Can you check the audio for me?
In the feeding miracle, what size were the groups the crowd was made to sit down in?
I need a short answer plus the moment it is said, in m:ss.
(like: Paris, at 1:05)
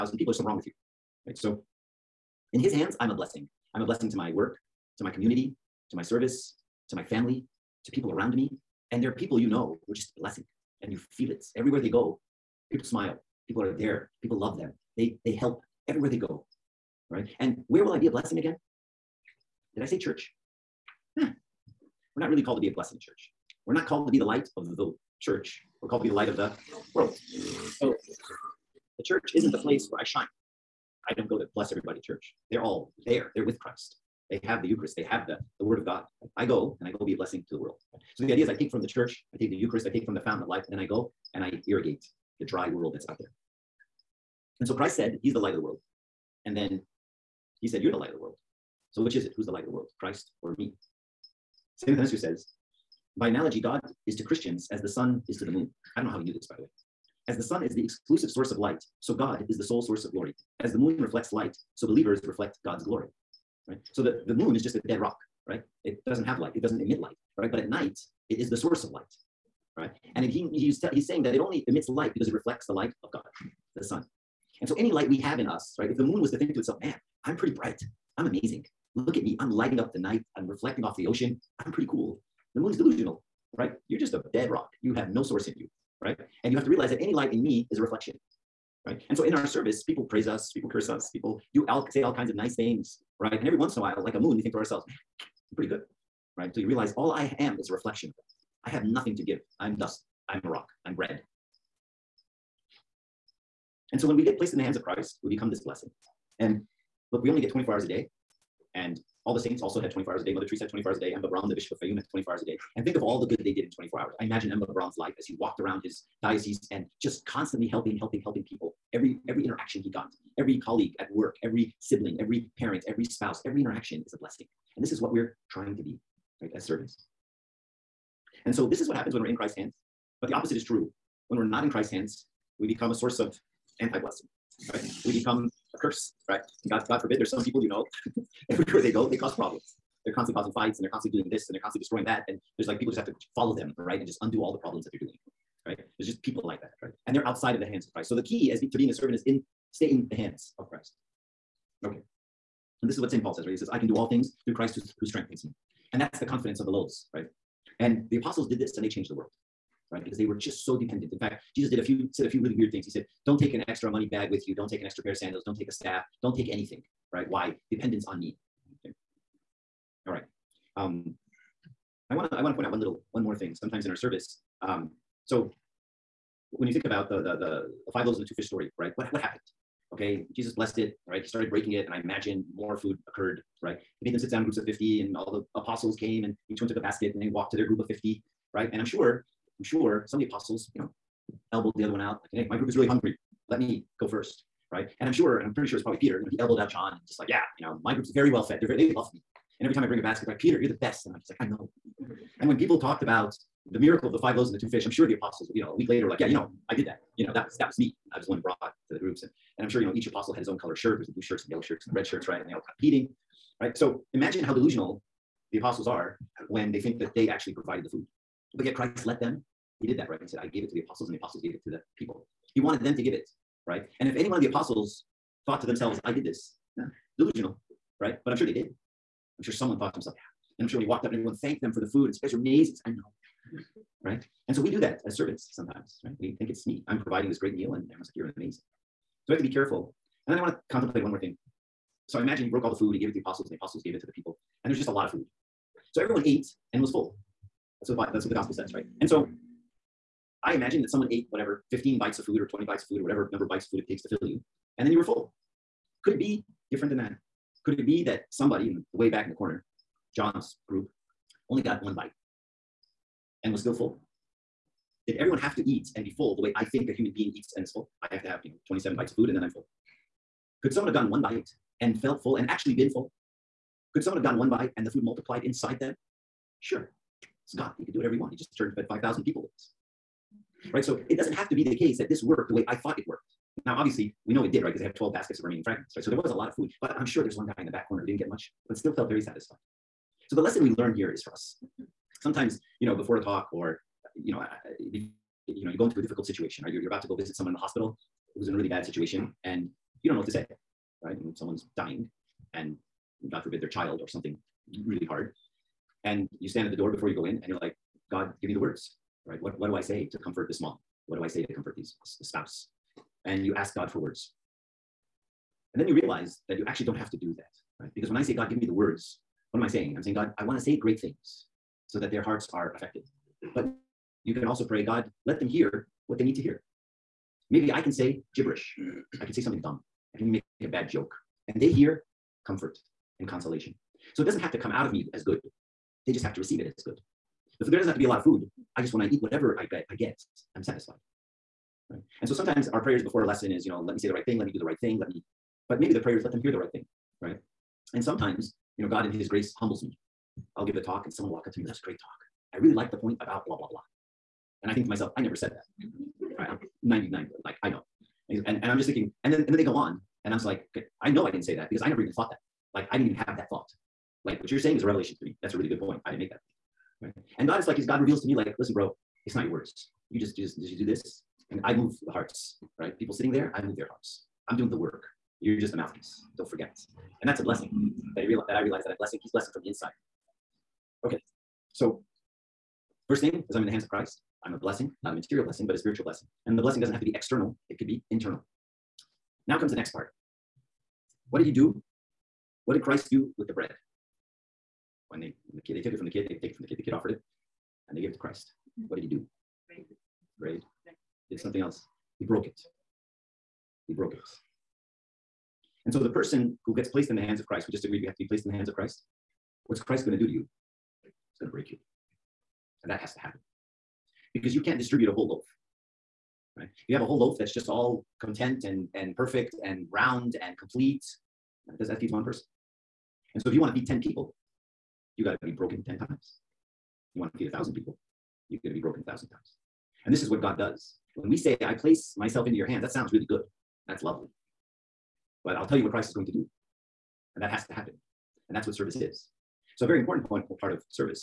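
50, at 3:04.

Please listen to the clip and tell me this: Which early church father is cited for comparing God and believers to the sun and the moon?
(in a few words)
St. Athanasius.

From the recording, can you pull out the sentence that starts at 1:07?
But at night, it is the source of light, right?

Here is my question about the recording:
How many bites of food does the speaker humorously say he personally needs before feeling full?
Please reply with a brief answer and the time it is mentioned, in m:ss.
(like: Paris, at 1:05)
27, at 4:28.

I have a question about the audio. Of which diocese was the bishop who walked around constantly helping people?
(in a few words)
Fayoum.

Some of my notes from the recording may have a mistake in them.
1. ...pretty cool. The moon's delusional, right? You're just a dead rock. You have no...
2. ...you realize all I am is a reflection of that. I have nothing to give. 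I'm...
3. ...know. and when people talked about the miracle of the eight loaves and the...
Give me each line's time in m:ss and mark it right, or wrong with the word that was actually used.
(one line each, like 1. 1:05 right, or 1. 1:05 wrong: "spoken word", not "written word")
1. 1:21 right
2. 1:36 right
3. 3:21 wrong: "five", not "eight".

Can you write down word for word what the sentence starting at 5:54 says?
And I think to myself, I never said that.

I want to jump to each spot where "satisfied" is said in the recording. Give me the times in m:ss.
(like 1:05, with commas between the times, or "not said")
4:49, 5:40.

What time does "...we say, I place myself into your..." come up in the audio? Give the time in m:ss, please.
7:11.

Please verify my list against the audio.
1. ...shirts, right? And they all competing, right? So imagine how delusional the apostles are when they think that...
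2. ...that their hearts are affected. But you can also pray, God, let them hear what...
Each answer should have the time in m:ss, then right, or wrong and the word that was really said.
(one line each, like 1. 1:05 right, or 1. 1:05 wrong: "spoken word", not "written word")
1. 3:32 right
2. 5:21 right.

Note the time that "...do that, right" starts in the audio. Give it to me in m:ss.
5:17.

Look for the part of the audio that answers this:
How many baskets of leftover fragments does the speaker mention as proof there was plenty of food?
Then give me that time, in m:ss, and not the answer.
4:44.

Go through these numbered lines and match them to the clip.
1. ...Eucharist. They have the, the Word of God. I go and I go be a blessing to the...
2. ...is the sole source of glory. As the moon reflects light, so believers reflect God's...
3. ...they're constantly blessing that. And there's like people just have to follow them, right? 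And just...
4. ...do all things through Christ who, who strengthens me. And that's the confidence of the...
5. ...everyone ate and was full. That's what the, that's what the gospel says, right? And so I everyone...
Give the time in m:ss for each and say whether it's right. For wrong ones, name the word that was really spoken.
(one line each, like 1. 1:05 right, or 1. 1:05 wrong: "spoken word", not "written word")
1. 0:34 right
2. 0:59 right
3. 2:21 wrong: "destroying", not "blessing"
4. 2:33 right
5. 4:05 wrong: "imagine", not "everyone".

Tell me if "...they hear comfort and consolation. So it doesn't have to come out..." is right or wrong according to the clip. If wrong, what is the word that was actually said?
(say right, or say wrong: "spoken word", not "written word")
right.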